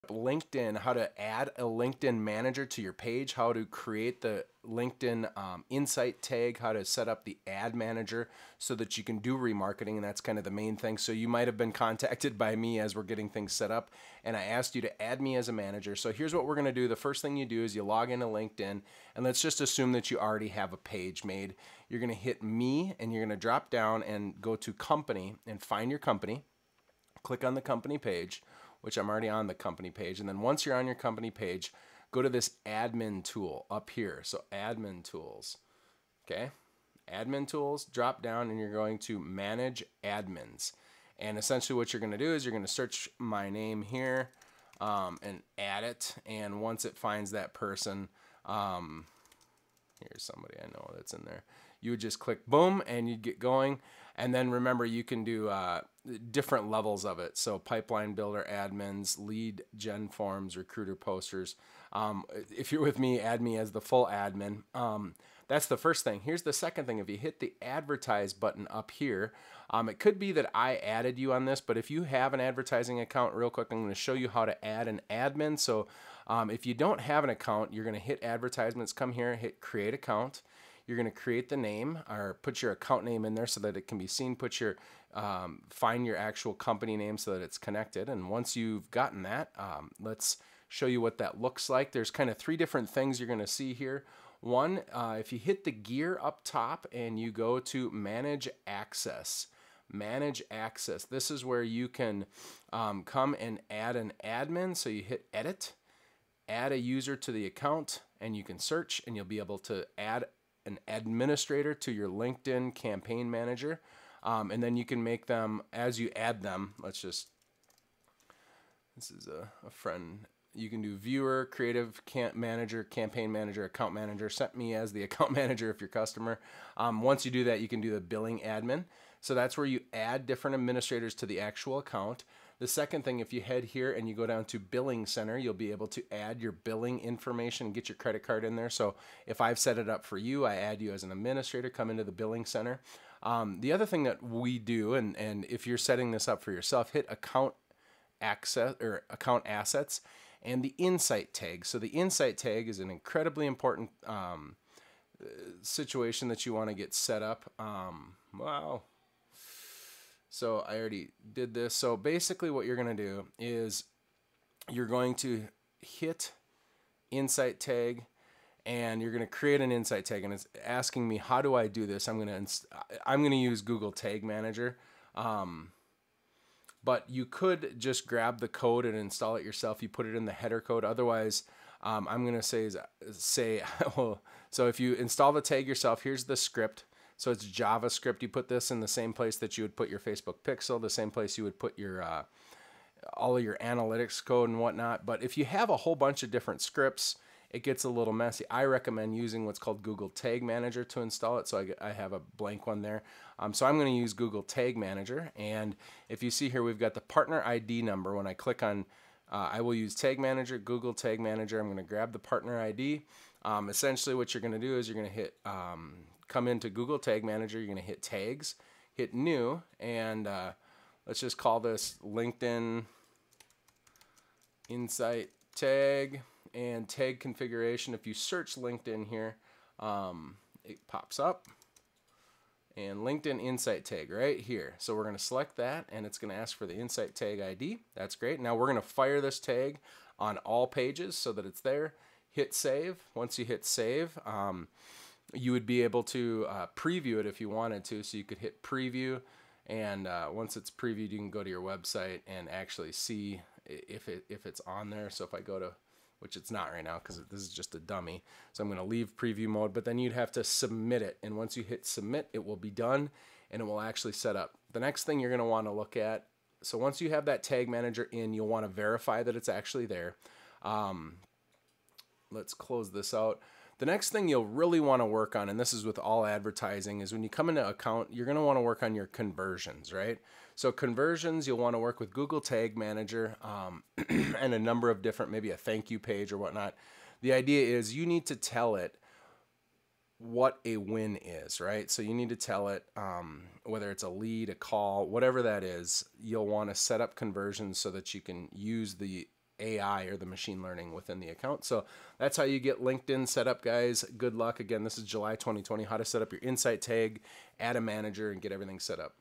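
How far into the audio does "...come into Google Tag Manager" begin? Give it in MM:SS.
03:36.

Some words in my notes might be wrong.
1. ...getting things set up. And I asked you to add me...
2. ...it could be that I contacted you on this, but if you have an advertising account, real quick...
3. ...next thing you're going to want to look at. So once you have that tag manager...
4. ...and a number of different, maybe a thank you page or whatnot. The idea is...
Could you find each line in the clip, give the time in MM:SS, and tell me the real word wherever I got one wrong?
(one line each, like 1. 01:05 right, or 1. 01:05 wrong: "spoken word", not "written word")
1. 00:13 right
2. 01:09 wrong: "added", not "contacted"
3. 04:24 right
4. 04:44 right.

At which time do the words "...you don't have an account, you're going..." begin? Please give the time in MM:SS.
01:16.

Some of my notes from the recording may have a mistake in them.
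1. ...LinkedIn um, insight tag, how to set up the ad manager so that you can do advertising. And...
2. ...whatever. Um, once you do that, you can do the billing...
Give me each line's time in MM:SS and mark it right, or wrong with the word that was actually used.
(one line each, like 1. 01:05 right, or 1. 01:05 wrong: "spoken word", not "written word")
1. 00:04 wrong: "remarketing", not "advertising"
2. 02:05 wrong: "customer", not "whatever".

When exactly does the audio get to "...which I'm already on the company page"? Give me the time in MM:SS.
00:28.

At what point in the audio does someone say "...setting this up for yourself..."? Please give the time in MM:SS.
02:25.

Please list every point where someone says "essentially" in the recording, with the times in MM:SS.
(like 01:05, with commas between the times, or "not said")
00:41, 03:33.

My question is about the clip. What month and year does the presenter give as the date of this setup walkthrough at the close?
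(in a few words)
July 2020.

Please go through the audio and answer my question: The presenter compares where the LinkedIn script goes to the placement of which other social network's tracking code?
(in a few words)
Facebook pixel.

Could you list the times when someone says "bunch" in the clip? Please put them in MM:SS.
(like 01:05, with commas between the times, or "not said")
03:15.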